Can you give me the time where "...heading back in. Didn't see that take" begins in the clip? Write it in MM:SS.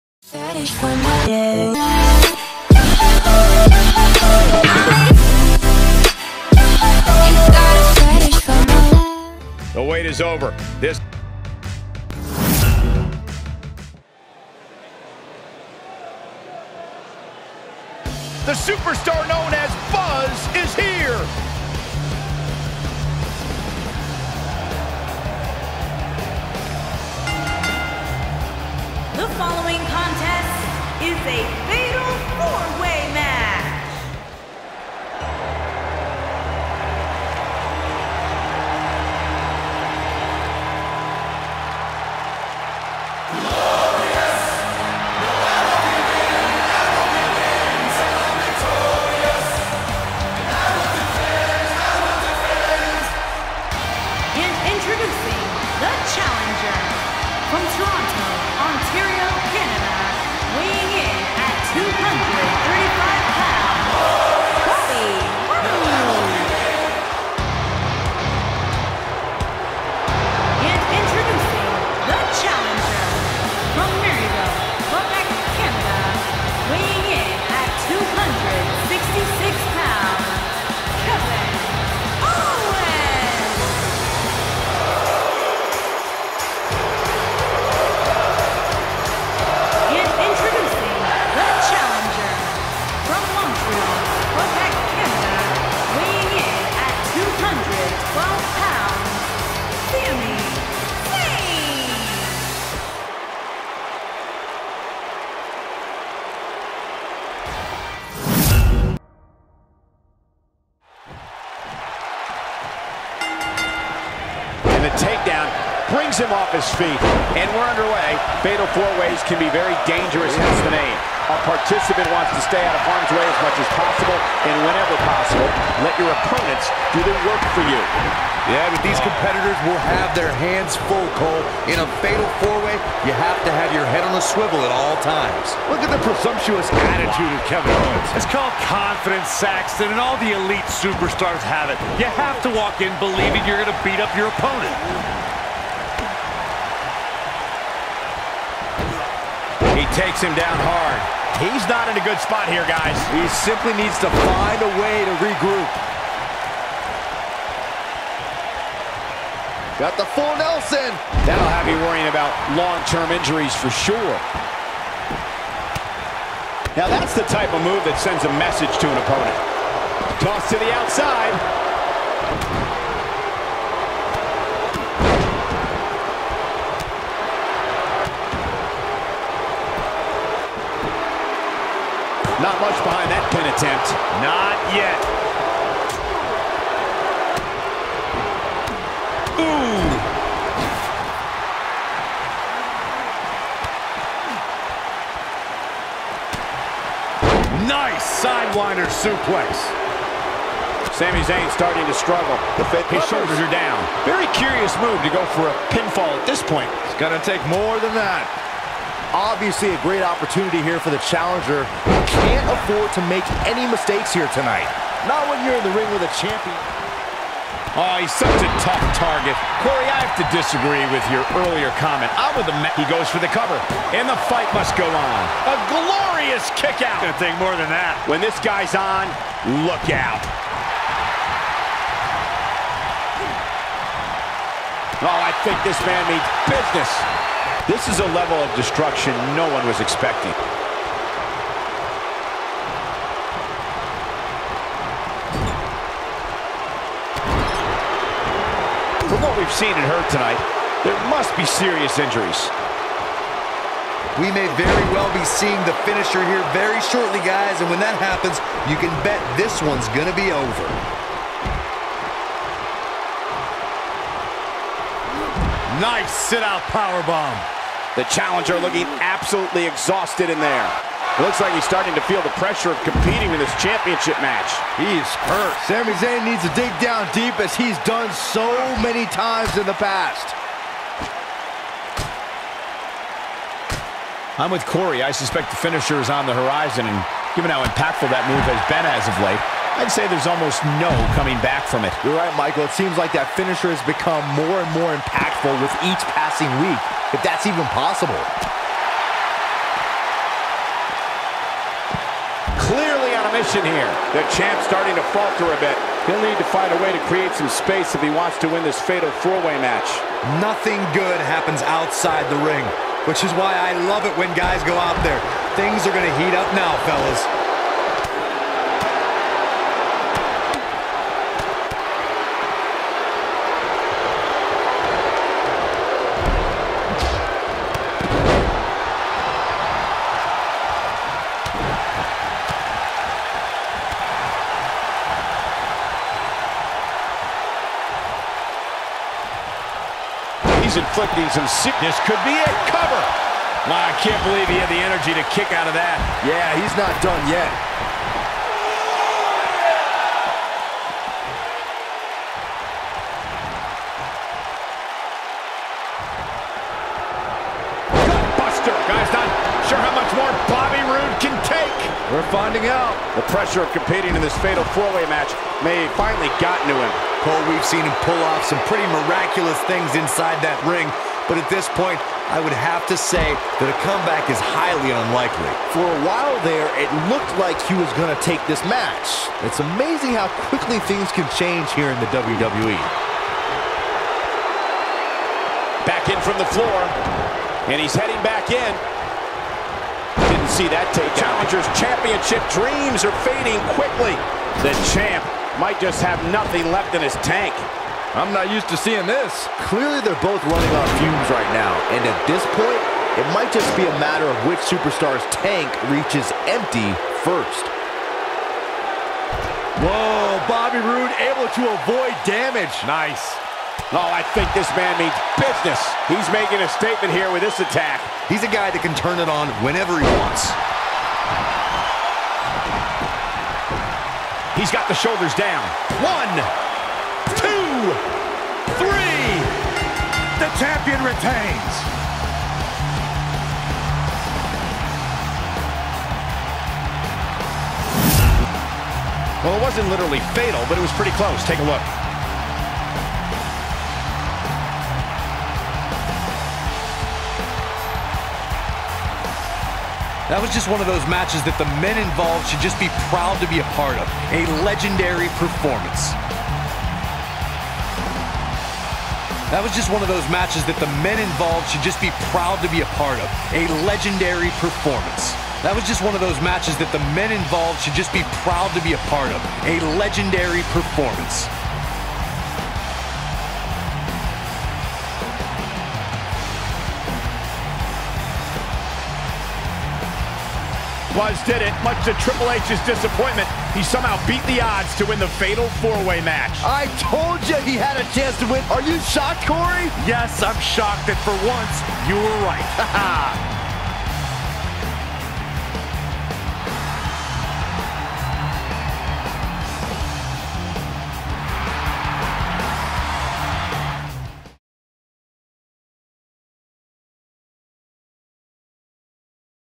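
06:27.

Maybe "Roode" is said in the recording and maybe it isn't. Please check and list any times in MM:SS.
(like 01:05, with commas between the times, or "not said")
06:00, 06:50.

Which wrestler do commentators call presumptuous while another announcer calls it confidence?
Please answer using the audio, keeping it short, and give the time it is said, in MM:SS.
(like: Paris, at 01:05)
Kevin Owens, at 02:17.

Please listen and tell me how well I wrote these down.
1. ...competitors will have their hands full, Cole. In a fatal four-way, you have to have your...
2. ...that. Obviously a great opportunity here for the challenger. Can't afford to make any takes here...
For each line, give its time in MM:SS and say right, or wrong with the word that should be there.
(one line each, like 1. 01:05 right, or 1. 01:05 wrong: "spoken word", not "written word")
1. 02:08 right
2. 03:27 wrong: "mistakes", not "takes".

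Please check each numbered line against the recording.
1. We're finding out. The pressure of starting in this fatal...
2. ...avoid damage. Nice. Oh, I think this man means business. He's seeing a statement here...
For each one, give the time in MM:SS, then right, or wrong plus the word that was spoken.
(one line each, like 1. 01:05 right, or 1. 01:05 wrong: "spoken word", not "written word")
1. 06:02 wrong: "competing", not "starting"
2. 06:51 wrong: "making", not "seeing".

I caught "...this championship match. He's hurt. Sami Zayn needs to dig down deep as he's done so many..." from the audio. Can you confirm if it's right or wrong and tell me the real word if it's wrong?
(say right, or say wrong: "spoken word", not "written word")
right.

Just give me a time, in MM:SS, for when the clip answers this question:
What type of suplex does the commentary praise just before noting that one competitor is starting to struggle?
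03:18.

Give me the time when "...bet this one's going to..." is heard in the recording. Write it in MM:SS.
04:19.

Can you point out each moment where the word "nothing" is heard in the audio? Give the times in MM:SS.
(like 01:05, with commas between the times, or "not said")
05:10, 06:36.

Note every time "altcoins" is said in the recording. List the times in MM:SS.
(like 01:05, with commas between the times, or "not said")
not said.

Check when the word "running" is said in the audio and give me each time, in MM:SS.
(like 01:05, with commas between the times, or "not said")
06:40.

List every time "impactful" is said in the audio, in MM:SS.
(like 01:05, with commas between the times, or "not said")
04:47, 04:54.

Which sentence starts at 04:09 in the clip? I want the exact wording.
From what we've seen in her tonight, there must be serious injuries.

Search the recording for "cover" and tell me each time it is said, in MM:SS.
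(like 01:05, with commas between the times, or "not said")
03:43, 05:42.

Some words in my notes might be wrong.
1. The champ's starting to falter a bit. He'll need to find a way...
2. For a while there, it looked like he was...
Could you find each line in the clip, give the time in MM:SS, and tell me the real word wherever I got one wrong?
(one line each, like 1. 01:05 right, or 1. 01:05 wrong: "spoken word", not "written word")
1. 05:04 right
2. 06:15 right.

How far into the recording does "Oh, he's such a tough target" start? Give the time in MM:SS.
03:37.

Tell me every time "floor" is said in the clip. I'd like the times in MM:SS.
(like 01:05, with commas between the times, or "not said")
06:26.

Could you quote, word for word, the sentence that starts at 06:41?
And at this point, it might just be a matter of which superstar's tank reaches empty first.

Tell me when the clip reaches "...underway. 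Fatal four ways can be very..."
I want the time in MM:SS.
01:57.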